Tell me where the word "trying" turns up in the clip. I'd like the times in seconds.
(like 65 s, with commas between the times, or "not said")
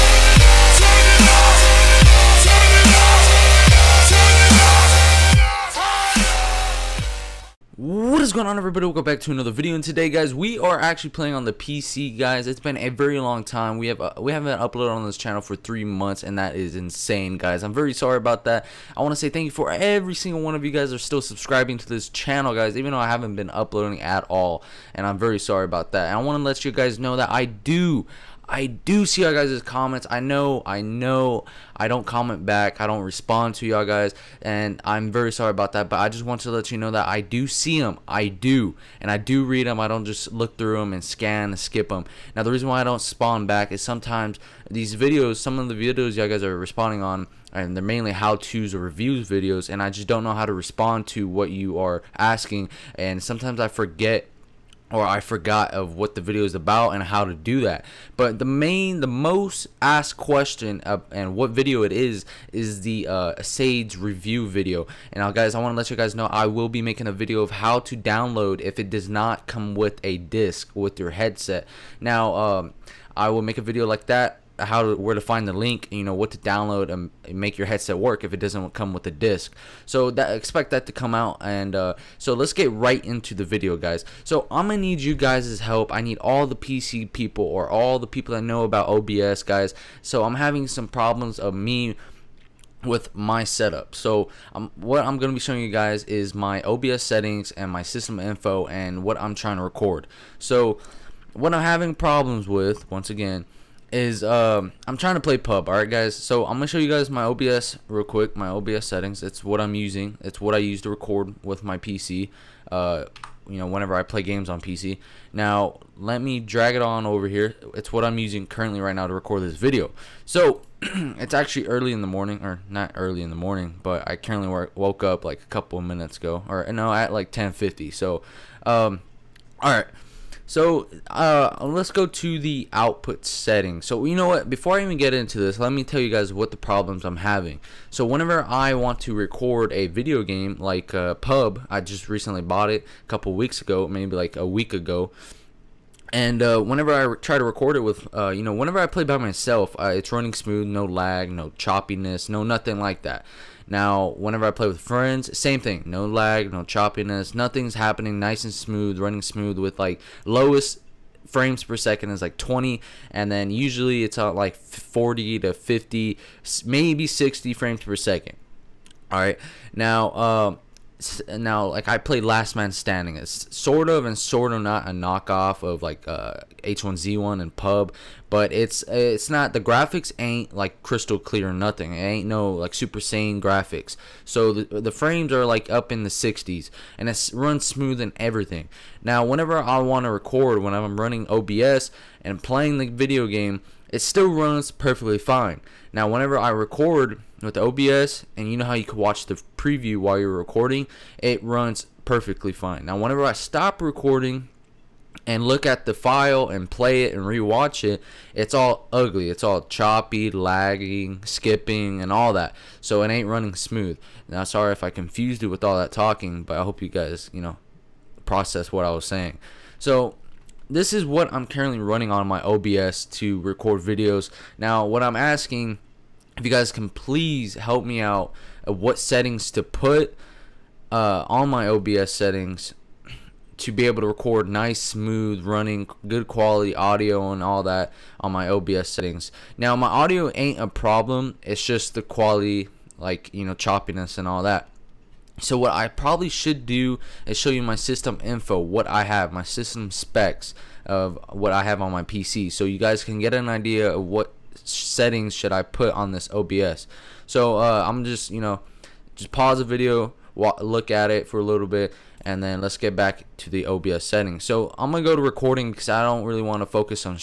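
99 s, 104 s.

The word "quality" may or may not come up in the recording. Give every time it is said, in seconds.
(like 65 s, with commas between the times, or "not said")
236 s, 242 s.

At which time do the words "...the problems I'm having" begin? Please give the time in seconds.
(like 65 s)
136 s.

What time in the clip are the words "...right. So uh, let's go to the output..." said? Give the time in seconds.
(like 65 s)
129 s.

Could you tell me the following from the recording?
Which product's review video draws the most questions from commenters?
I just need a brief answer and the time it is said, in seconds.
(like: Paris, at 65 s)
Sage, at 63 s.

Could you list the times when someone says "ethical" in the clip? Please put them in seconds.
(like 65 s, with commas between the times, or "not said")
not said.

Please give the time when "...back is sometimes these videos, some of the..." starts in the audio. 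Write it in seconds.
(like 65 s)
43 s.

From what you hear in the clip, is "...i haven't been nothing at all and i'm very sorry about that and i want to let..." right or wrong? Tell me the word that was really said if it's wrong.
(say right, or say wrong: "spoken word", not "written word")
wrong: "uploading", not "nothing".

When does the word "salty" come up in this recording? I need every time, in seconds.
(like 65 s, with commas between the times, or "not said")
not said.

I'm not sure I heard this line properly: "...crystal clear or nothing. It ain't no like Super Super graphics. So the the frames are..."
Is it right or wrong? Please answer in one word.
wrong.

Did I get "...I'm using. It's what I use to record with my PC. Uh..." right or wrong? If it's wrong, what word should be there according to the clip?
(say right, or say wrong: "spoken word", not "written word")
right.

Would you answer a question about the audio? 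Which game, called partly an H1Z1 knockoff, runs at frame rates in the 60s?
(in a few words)
Last Man Standing.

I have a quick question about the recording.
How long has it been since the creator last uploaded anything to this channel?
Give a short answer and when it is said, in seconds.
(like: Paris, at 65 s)
3 months, at 15 s.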